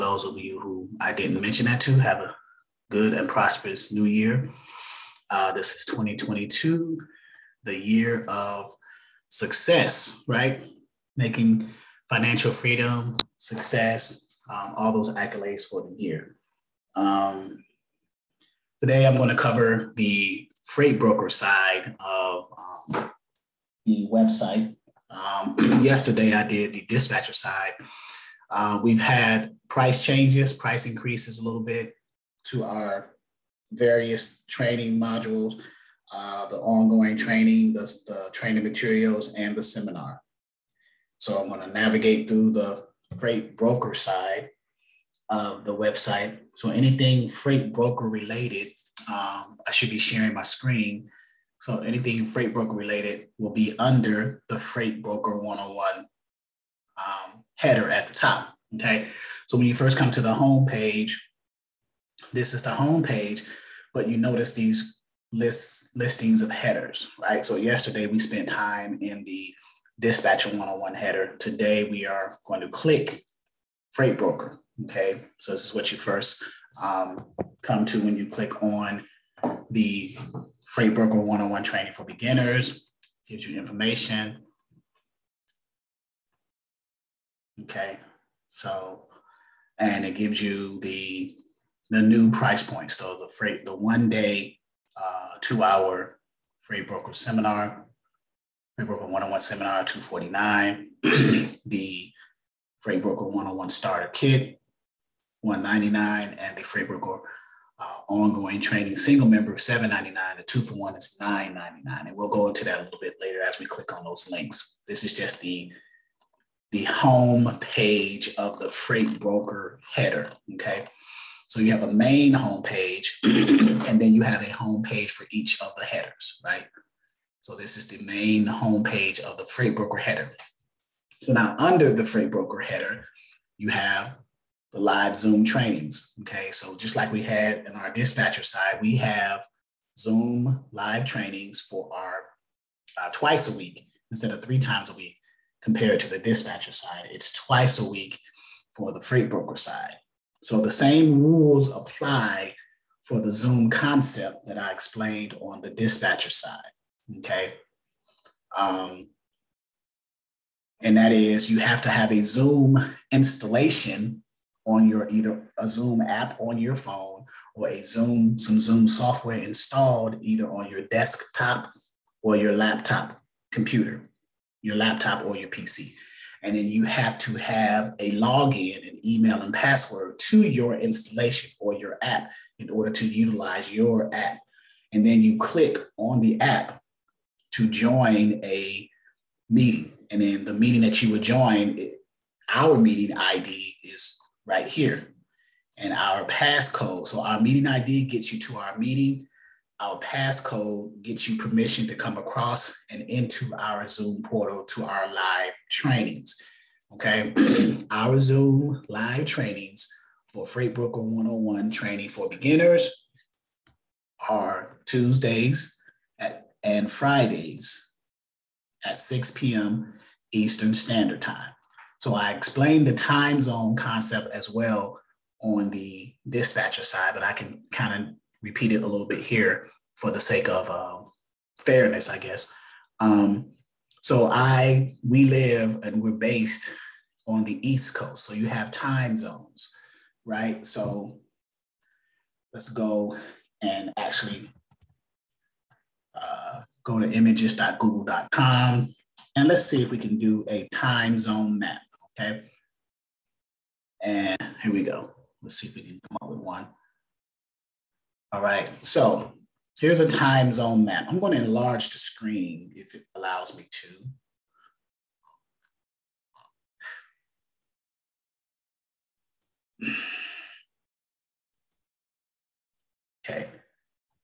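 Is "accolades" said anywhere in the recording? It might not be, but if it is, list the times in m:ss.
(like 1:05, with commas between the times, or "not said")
0:15.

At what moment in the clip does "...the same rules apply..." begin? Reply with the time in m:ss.
2:30.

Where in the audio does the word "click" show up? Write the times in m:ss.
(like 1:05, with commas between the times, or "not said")
1:12, 1:18, 1:53, 3:05.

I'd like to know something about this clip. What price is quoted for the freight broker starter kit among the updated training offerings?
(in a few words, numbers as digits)
$199.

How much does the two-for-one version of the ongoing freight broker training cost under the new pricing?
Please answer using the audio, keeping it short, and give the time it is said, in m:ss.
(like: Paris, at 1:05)
$999, at 1:51.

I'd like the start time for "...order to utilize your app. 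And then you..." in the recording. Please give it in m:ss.
3:02.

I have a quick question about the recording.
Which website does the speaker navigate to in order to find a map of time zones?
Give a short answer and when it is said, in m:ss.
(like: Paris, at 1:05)
images.google.com, at 4:07.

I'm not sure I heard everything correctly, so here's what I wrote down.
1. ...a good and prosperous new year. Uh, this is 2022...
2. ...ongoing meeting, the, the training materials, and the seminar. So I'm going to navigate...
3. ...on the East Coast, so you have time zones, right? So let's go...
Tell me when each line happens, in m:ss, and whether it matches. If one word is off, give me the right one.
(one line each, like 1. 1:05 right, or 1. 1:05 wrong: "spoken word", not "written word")
1. 0:02 right
2. 0:36 wrong: "training", not "meeting"
3. 3:57 right.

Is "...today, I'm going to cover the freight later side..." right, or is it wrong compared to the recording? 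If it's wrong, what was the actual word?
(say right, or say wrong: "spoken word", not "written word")
wrong: "broker", not "later".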